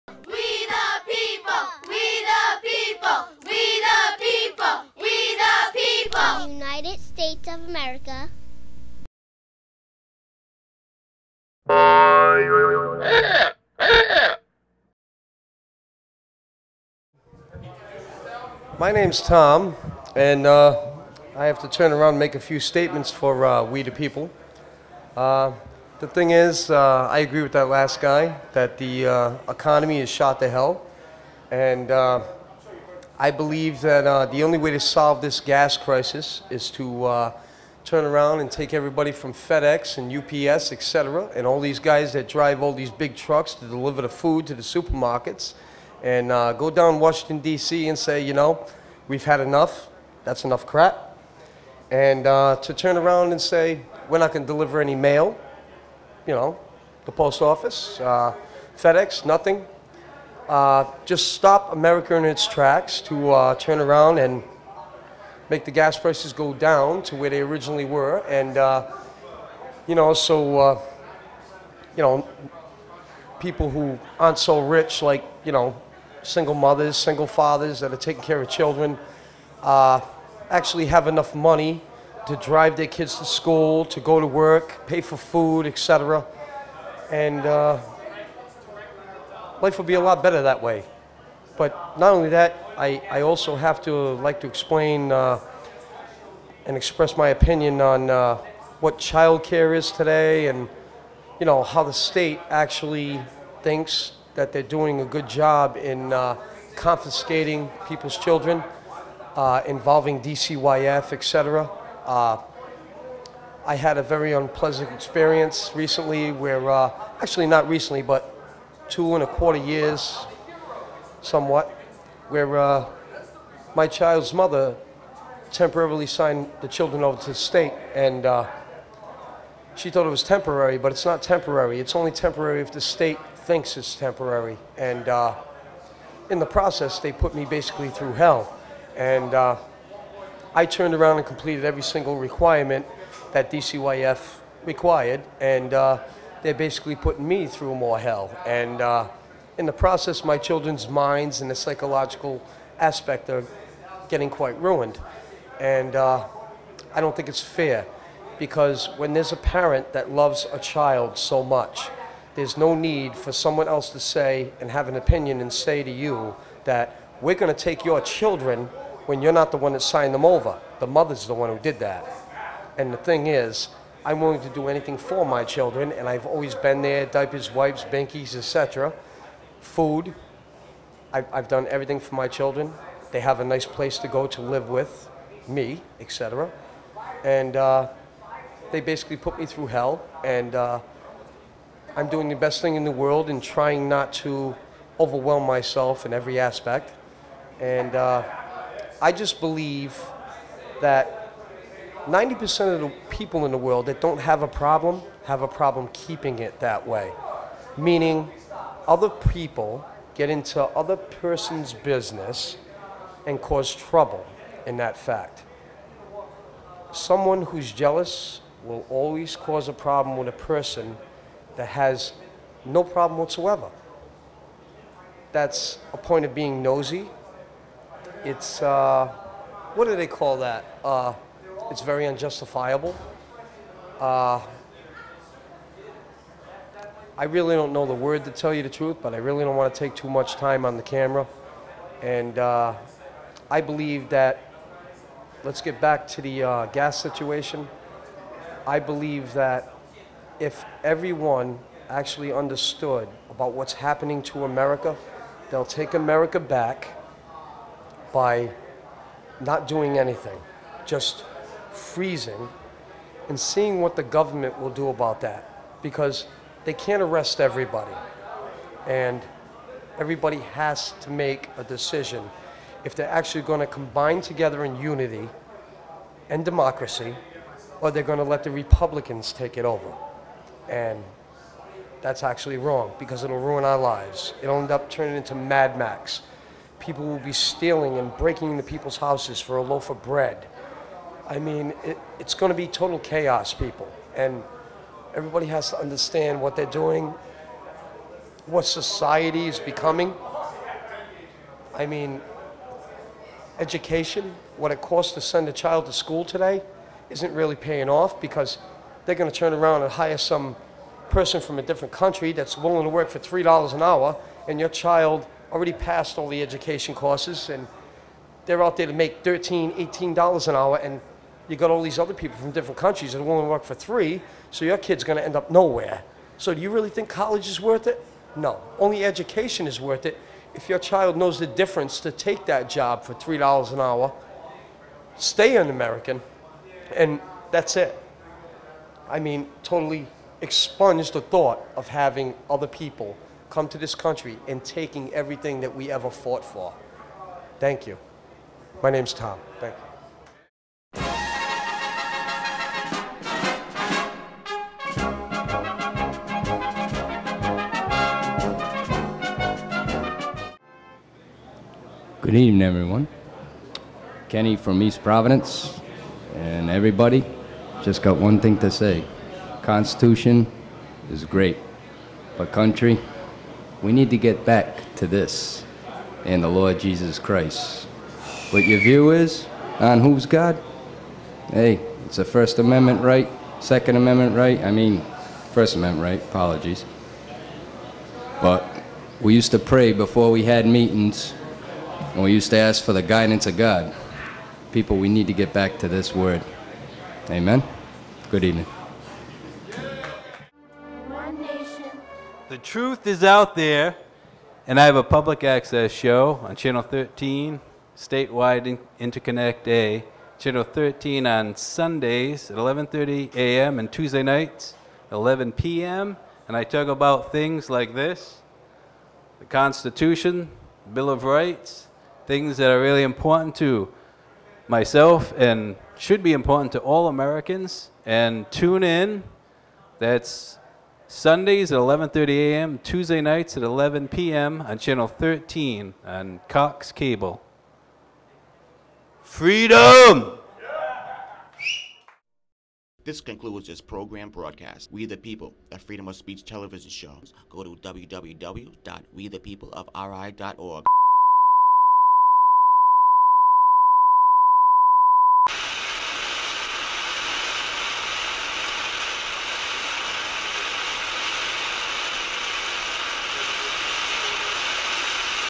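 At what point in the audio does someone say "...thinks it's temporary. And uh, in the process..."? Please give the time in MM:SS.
02:13.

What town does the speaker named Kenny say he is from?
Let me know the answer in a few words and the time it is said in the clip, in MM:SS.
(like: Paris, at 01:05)
East Providence, at 06:04.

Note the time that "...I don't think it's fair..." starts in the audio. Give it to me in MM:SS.
02:36.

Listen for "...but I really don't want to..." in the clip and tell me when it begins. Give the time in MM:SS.
03:59.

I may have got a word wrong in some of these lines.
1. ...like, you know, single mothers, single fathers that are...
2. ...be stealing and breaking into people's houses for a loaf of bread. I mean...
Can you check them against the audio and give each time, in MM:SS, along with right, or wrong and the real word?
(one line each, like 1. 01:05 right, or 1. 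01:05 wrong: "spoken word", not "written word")
1. 01:15 right
2. 04:47 right.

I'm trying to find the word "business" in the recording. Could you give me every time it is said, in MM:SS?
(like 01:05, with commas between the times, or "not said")
03:31.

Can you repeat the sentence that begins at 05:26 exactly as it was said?
So do you really think college is worth it?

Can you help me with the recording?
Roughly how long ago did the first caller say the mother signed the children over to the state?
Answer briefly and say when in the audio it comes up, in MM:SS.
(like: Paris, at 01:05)
two and a quarter years, at 01:58.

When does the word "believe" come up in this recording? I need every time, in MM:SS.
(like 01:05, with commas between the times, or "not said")
00:33, 03:19, 04:03, 04:08.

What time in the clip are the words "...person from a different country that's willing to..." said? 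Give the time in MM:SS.
05:11.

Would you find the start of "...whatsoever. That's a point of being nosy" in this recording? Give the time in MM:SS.
03:43.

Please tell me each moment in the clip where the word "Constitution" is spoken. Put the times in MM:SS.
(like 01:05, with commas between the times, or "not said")
06:09, 06:59.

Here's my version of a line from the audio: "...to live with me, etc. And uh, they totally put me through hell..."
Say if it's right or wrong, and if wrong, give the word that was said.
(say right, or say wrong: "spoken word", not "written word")
wrong: "basically", not "totally".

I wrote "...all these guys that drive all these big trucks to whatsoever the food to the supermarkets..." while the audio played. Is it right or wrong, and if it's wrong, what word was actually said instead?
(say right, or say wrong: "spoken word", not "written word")
wrong: "deliver", not "whatsoever".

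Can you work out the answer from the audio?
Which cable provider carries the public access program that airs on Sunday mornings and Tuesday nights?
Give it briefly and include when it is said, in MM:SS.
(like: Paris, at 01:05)
Cox Cable, at 07:16.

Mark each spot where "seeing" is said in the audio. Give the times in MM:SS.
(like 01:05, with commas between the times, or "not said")
04:23.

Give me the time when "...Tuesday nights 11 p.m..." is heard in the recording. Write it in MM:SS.
06:53.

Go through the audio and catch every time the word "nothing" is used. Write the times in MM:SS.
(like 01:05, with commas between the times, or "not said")
00:59.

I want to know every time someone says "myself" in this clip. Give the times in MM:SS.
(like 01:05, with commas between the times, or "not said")
03:15, 07:04.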